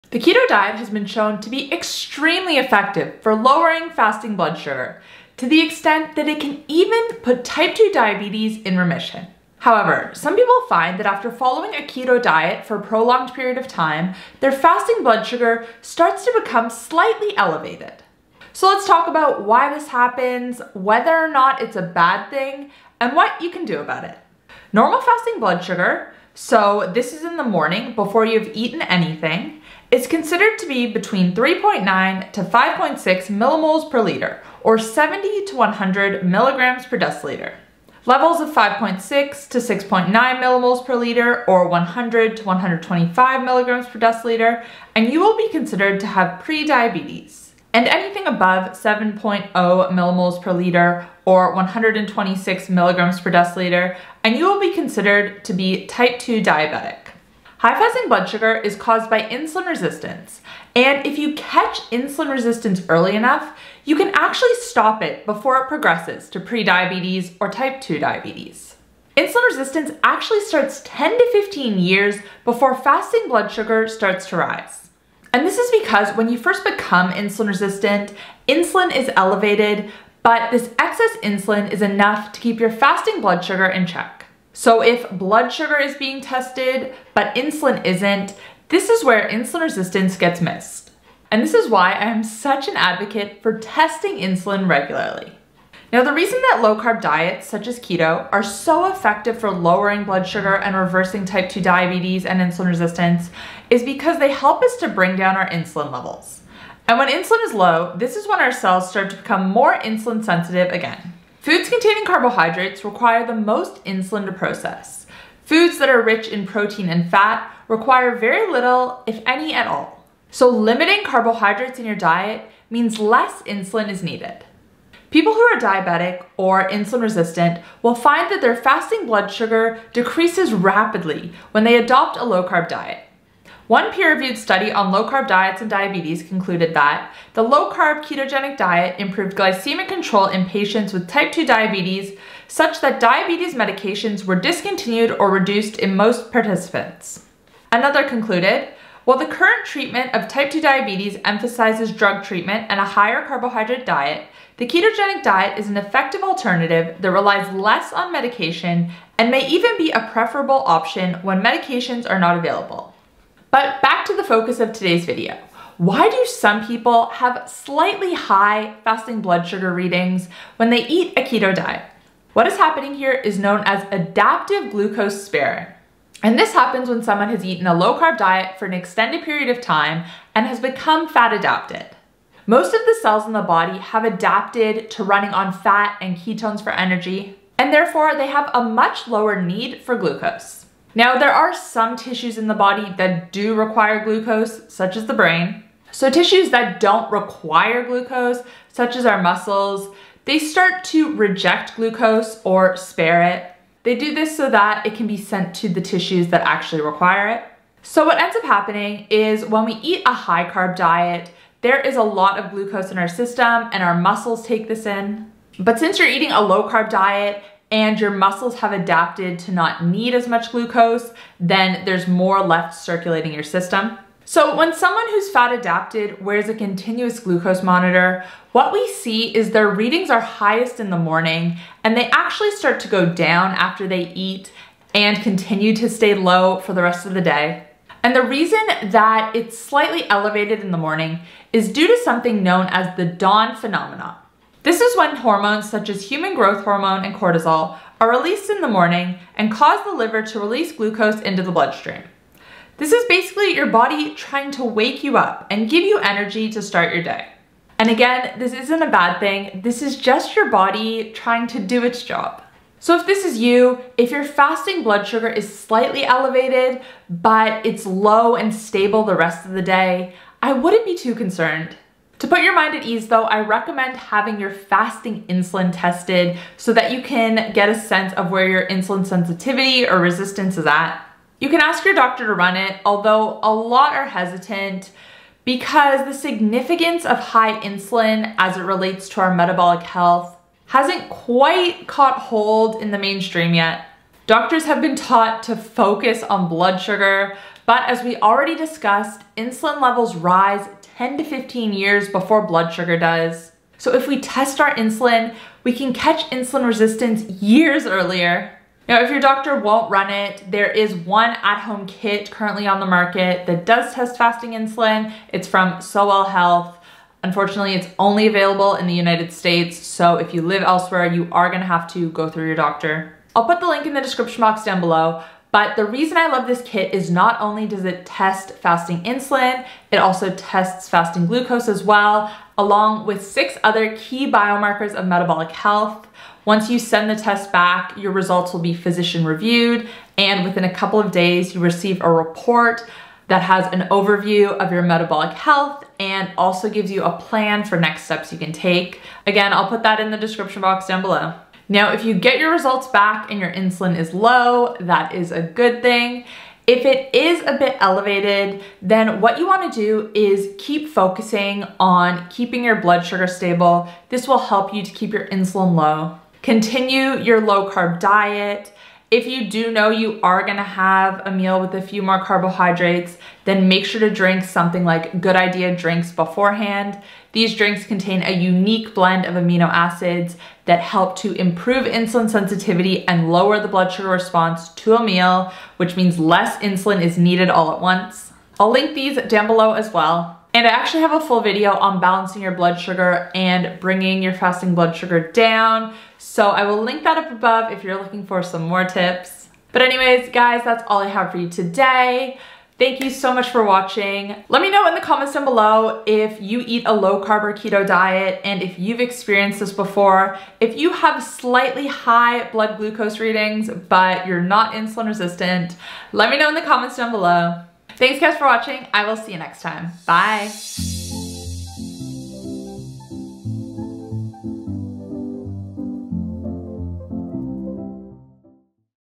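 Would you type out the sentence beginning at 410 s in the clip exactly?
If you have slightly high blood glucose readings, but you're not insulin resistant, let me know in the comments down below.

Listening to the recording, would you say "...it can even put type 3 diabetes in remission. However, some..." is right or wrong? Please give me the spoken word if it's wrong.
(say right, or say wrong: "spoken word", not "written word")
wrong: "2", not "3".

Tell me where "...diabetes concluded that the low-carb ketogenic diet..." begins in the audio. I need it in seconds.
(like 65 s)
135 s.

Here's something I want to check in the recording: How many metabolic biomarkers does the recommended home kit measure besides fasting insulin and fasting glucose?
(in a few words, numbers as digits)
6.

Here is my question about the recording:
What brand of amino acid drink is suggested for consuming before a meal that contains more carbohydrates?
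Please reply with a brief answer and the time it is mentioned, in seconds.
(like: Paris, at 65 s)
Good Idea, at 375 s.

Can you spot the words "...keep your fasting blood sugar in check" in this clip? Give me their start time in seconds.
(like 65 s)
82 s.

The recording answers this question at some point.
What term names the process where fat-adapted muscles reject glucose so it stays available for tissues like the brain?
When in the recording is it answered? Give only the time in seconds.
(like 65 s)
173 s.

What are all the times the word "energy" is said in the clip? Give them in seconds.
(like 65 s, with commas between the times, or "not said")
186 s, 255 s.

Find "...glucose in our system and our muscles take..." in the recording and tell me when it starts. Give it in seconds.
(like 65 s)
212 s.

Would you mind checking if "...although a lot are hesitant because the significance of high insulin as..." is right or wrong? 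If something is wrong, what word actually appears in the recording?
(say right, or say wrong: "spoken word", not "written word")
right.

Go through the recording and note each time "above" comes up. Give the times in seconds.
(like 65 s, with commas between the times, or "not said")
48 s, 397 s.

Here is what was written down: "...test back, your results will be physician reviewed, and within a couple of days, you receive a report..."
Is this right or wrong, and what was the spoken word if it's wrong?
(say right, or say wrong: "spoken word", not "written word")
right.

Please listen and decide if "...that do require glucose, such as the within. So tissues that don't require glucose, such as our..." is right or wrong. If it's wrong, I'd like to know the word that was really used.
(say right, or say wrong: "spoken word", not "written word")
wrong: "brain", not "within".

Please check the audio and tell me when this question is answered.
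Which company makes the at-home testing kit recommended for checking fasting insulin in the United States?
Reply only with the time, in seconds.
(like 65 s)
315 s.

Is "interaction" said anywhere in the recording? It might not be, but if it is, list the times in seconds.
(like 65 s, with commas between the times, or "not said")
not said.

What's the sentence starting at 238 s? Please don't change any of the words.
And the reason that it's slightly elevated in the morning is due to something known as the dawn phenomenon.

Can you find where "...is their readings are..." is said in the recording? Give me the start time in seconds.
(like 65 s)
229 s.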